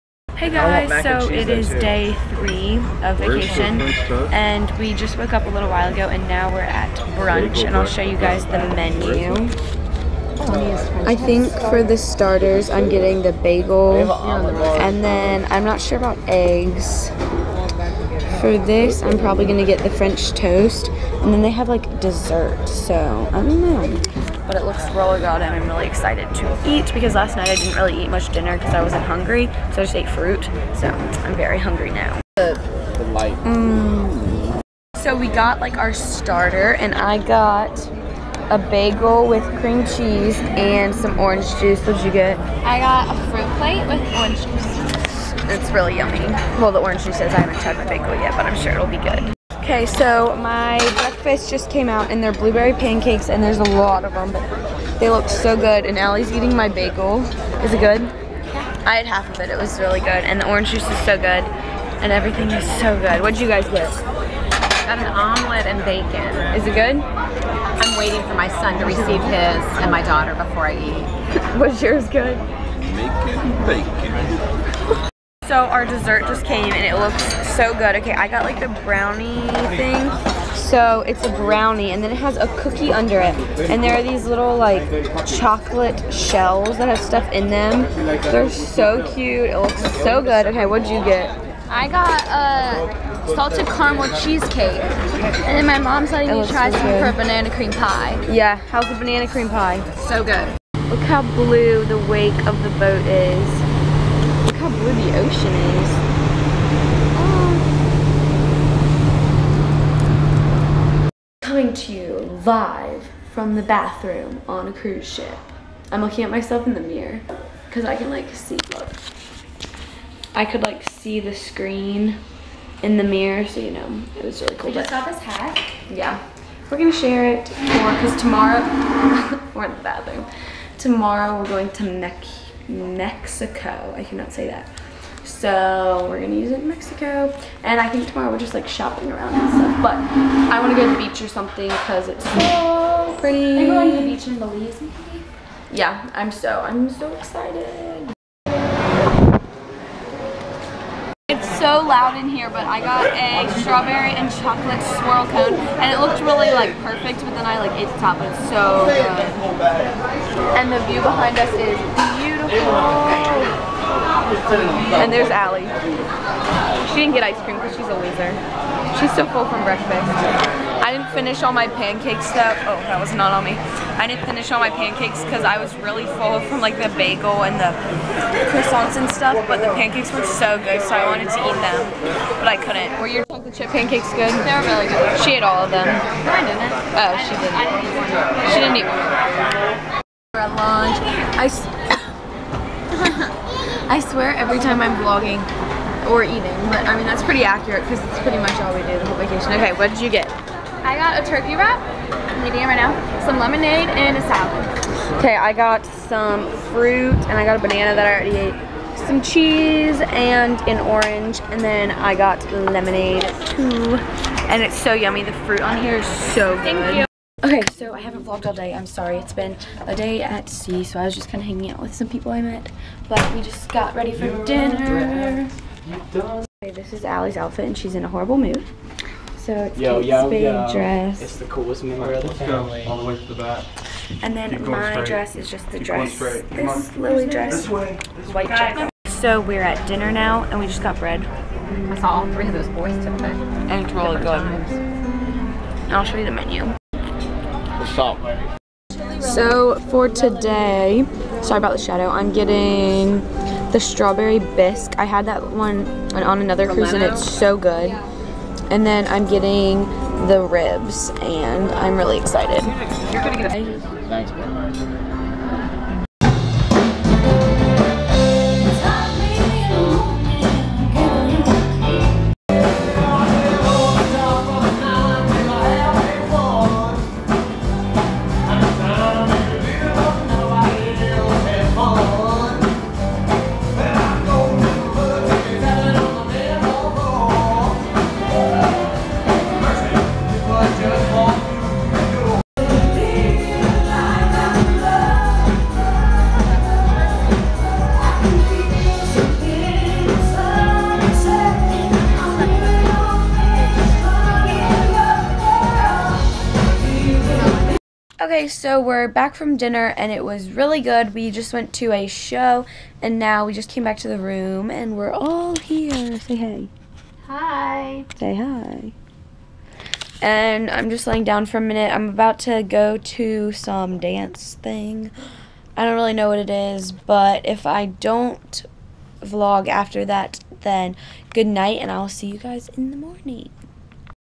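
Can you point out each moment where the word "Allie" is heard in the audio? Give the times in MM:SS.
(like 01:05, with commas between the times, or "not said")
00:55, 02:45, 03:47.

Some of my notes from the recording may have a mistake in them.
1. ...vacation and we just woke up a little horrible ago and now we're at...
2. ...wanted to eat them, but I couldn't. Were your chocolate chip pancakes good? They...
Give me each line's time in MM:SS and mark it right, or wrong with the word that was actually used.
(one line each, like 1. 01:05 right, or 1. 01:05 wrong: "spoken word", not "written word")
1. 00:03 wrong: "while", not "horrible"
2. 03:01 right.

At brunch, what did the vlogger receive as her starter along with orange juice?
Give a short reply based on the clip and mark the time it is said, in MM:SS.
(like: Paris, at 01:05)
bagel with cream cheese, at 00:38.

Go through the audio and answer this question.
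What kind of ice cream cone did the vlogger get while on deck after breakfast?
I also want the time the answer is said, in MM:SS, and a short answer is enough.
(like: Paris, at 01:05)
strawberry and chocolate swirl, at 02:33.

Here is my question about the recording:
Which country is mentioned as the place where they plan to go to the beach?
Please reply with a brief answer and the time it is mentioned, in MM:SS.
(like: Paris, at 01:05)
Belize, at 02:24.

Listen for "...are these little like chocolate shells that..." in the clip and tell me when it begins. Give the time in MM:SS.
01:23.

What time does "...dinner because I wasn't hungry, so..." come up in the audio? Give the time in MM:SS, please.
00:28.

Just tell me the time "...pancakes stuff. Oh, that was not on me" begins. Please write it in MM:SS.
02:51.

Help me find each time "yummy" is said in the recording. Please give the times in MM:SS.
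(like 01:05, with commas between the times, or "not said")
00:45, 03:34.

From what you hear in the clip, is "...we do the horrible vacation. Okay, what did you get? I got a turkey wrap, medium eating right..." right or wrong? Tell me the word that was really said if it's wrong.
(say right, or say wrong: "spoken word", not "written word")
wrong: "whole", not "horrible".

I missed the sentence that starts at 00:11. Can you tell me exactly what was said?
I think for the starters I'm getting the bagel and then I'm not sure about eggs.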